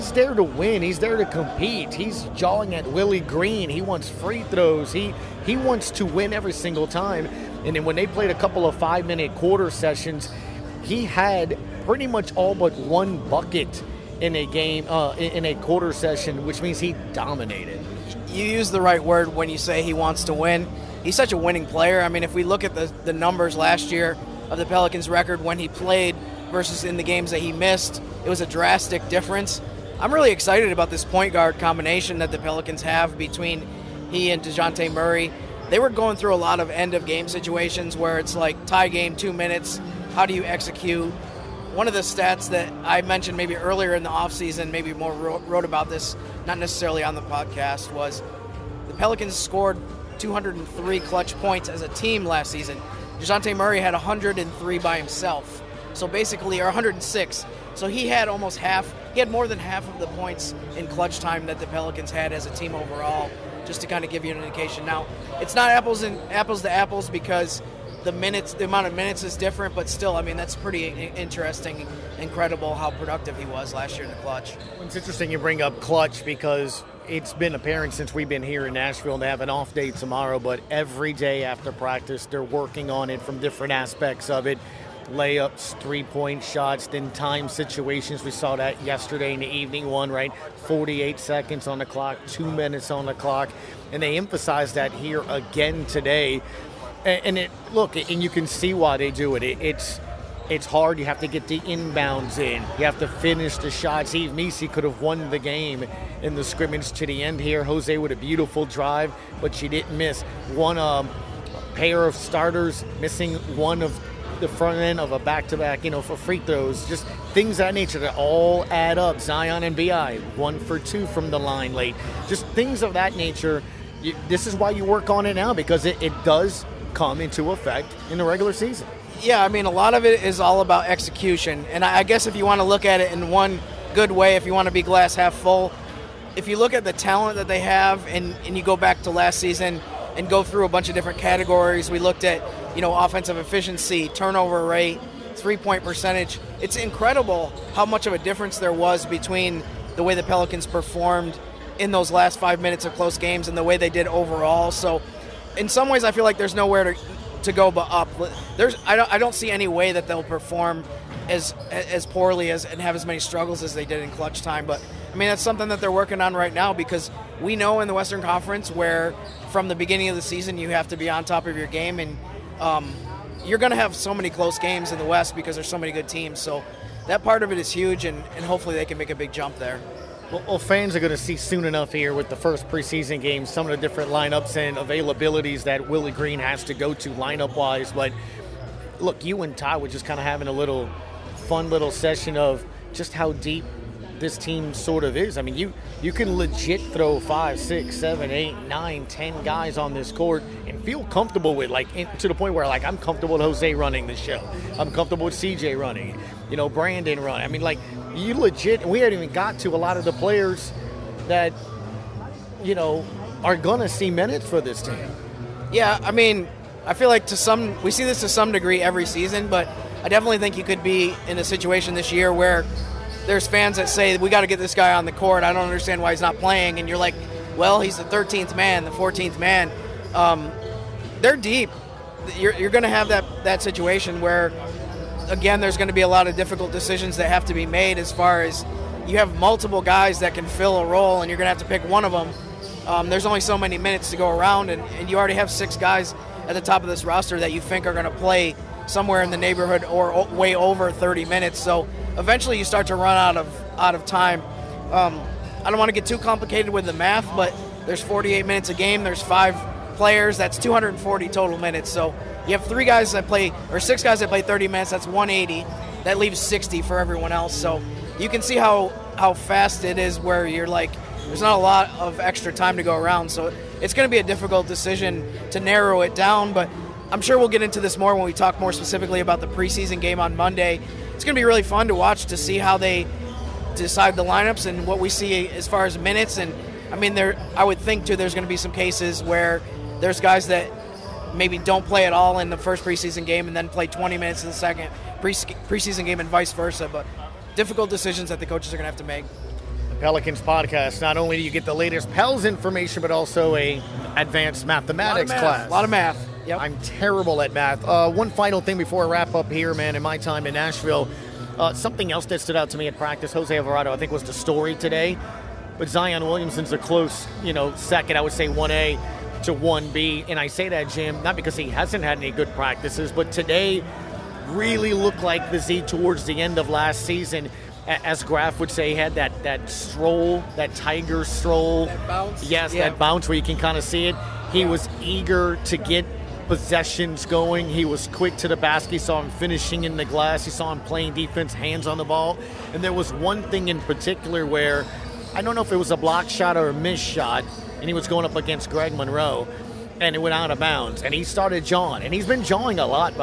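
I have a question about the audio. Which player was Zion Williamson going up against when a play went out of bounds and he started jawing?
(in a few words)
Greg Monroe.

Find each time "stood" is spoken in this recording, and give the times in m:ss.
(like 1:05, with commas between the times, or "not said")
5:12.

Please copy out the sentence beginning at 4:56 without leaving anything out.
But difficult decisions that the coaches are going to have to make.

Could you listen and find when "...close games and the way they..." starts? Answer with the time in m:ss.
2:32.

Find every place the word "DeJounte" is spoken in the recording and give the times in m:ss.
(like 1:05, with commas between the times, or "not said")
0:34, 0:53.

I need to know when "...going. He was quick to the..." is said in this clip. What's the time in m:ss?
5:37.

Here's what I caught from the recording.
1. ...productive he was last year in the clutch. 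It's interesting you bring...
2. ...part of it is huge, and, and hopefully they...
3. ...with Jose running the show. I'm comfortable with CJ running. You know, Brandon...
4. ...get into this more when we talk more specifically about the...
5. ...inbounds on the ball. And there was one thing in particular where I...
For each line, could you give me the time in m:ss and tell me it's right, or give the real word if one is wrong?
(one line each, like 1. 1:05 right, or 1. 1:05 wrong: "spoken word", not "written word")
1. 1:12 right
2. 2:57 right
3. 3:23 right
4. 4:37 right
5. 5:41 wrong: "hands", not "inbounds".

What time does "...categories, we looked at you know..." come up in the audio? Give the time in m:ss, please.
2:21.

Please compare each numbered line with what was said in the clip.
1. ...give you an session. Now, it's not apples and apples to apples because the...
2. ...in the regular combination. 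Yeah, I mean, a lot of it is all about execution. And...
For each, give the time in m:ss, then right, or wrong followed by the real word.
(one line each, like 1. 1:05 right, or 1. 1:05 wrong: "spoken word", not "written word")
1. 1:04 wrong: "indication", not "session"
2. 2:08 wrong: "season", not "combination".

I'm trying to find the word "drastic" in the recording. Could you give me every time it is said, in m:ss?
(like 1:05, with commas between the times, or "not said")
0:28.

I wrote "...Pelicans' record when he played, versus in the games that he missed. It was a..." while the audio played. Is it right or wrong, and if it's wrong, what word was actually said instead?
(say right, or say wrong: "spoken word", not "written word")
right.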